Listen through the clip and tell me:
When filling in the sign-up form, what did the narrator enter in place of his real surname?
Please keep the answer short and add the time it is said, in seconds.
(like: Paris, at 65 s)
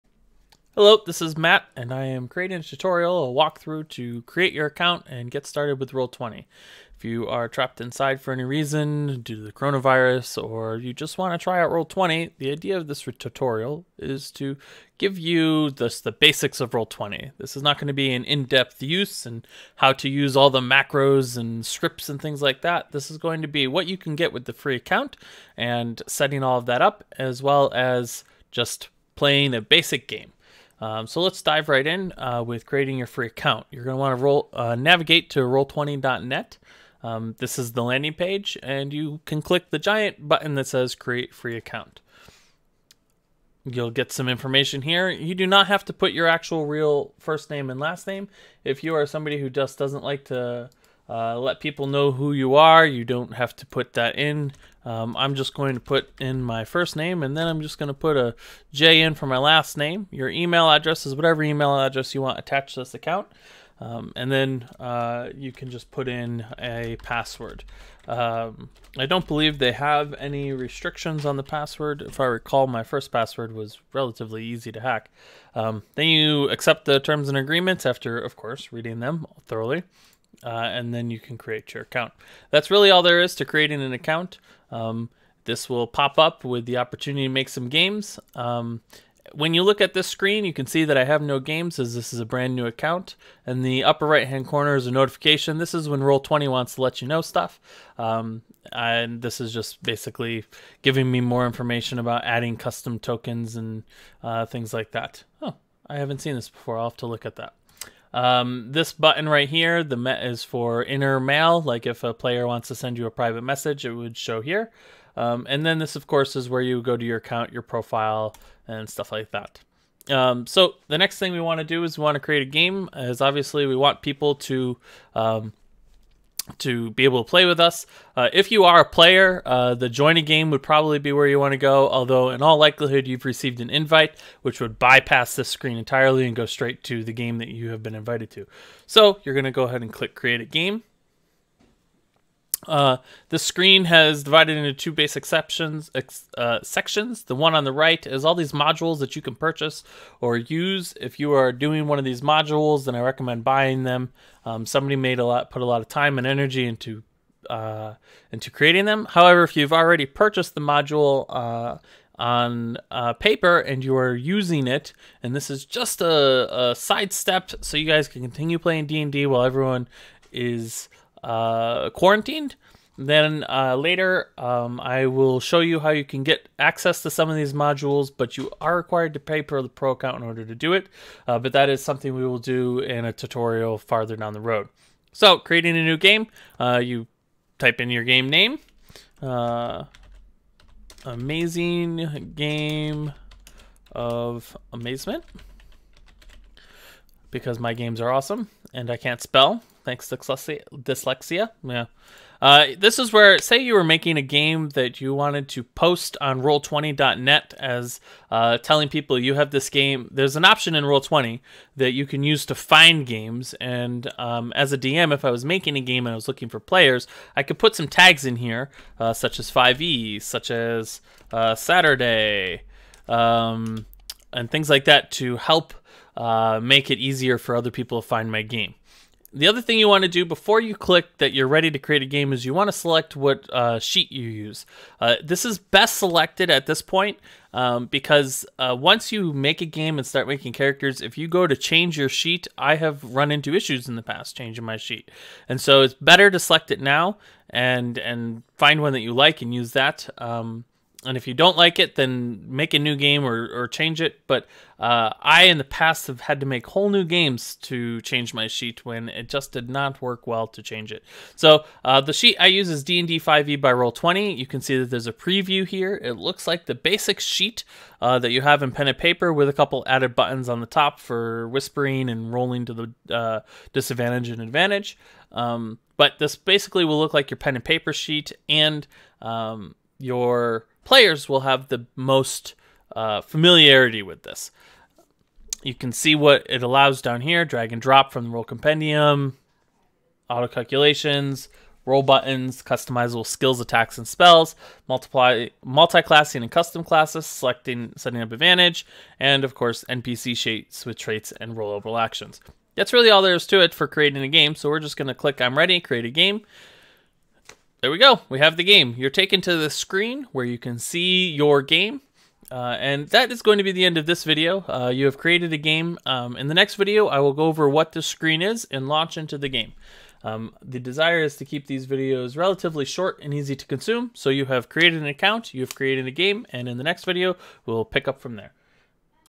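J, at 58 s.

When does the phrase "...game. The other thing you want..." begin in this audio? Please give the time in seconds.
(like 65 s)
228 s.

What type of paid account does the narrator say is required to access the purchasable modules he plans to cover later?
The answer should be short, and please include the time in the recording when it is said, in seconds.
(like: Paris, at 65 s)
Pro account, at 179 s.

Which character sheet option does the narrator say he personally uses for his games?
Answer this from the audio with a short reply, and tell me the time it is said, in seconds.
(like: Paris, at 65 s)
D&D 5e by Roll20, at 262 s.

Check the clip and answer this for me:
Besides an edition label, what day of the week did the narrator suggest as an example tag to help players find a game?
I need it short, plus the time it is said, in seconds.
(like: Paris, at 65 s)
Saturday, at 221 s.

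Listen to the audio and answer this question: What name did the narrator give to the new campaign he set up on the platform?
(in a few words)
Amazing game of amazement.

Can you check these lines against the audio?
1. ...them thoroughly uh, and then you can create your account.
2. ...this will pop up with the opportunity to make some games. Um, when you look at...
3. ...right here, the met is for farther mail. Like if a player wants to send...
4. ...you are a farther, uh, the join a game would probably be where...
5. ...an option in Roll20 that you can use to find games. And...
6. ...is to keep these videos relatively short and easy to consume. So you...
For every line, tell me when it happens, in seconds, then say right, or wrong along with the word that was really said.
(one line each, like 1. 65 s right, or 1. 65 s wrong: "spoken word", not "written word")
1. 79 s right
2. 85 s right
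3. 109 s wrong: "inner", not "farther"
4. 128 s wrong: "player", not "farther"
5. 210 s right
6. 321 s right.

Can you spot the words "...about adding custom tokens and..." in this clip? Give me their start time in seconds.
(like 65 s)
101 s.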